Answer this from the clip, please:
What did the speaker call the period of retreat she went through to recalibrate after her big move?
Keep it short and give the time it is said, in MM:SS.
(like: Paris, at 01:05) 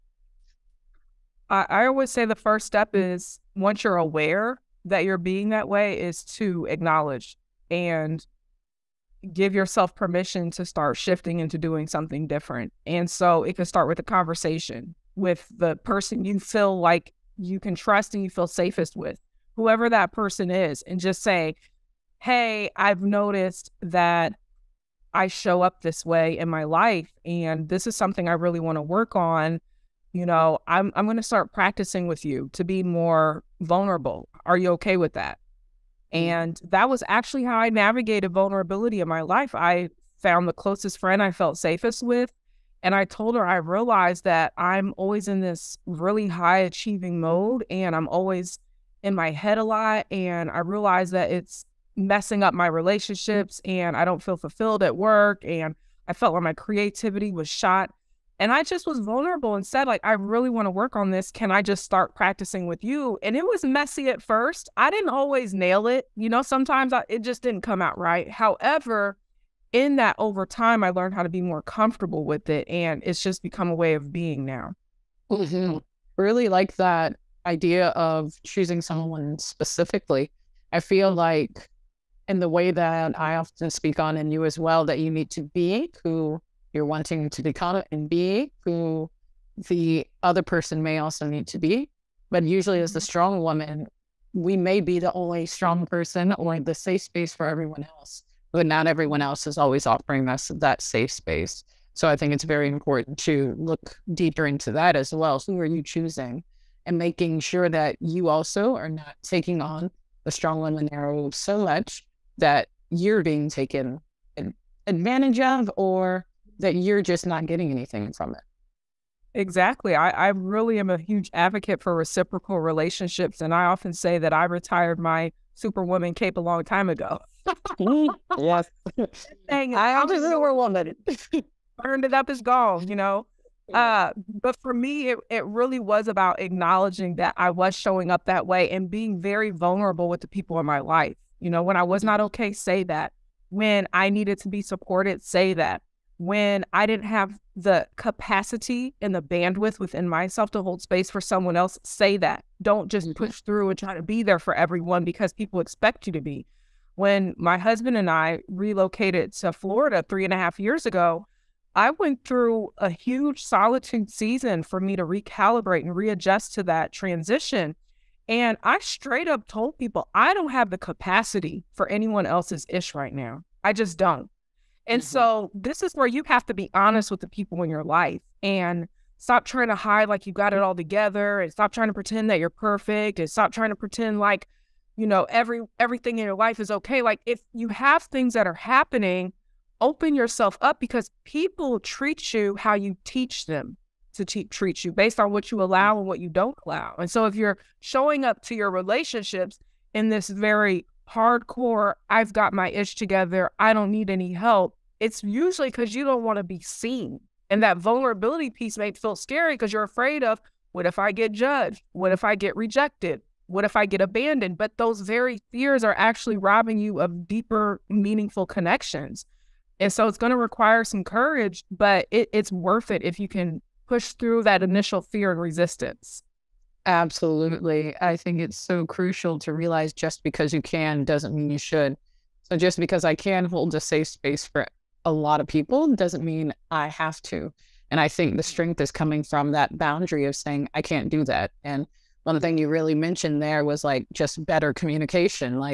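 solitude season, at 02:43.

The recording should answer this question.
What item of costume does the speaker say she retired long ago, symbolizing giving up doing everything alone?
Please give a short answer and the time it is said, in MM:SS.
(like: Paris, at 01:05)
superwoman cape, at 02:05.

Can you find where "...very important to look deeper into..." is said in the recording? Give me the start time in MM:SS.
01:42.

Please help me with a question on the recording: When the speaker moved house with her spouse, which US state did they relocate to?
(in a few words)
Florida.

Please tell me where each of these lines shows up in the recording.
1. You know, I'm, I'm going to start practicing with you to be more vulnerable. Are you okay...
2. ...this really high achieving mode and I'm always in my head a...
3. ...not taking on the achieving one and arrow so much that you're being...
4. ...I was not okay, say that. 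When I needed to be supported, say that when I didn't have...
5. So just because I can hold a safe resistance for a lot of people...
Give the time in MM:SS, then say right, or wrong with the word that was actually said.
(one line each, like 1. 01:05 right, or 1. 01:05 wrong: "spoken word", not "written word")
1. 00:30 right
2. 00:45 right
3. 01:48 wrong: "strong", not "achieving"
4. 02:21 right
5. 03:52 wrong: "space", not "resistance".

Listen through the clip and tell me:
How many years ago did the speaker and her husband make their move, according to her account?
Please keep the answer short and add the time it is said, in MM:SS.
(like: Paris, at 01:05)
3.5, at 02:40.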